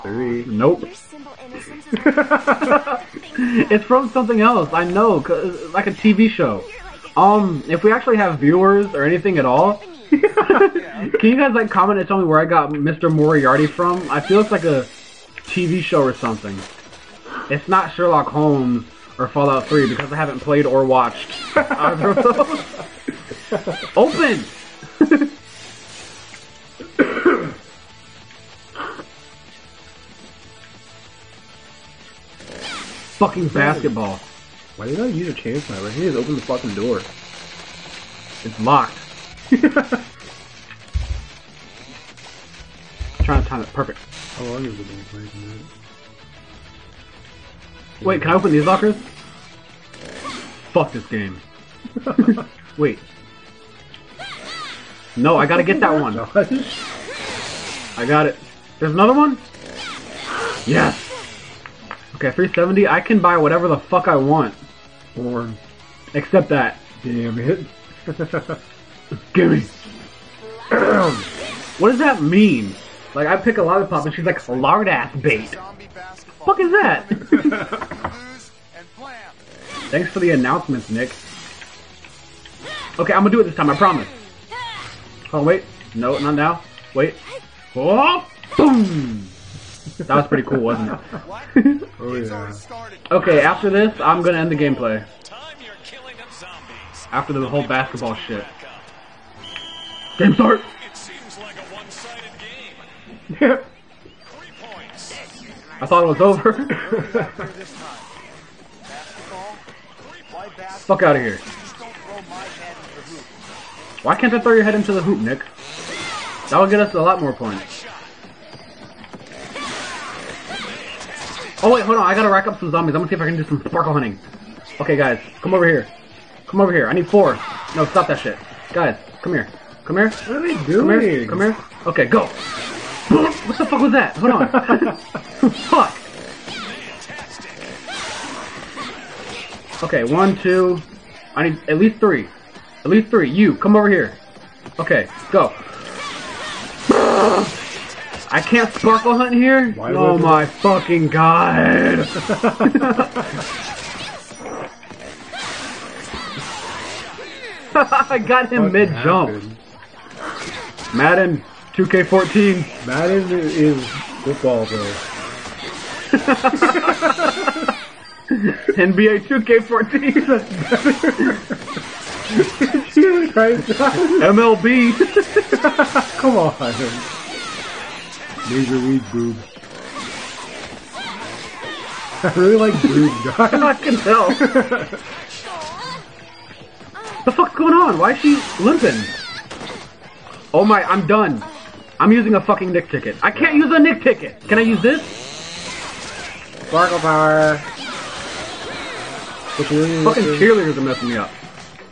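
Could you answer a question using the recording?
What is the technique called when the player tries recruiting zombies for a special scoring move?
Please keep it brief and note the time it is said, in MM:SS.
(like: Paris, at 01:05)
Sparkle hunting, at 02:03.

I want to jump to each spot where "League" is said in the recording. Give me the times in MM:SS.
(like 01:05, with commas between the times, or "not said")
02:58.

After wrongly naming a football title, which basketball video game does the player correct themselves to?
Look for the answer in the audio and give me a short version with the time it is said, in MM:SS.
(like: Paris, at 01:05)
NBA 2K14, at 02:48.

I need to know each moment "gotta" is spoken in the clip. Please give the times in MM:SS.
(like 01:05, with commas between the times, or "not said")
00:55, 02:02.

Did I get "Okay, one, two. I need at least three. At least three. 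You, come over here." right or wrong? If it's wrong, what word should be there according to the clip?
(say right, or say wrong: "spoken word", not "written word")
right.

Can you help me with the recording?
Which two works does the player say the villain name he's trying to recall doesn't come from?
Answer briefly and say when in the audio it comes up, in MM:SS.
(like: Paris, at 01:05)
Sherlock Holmes, Fallout 3, at 00:17.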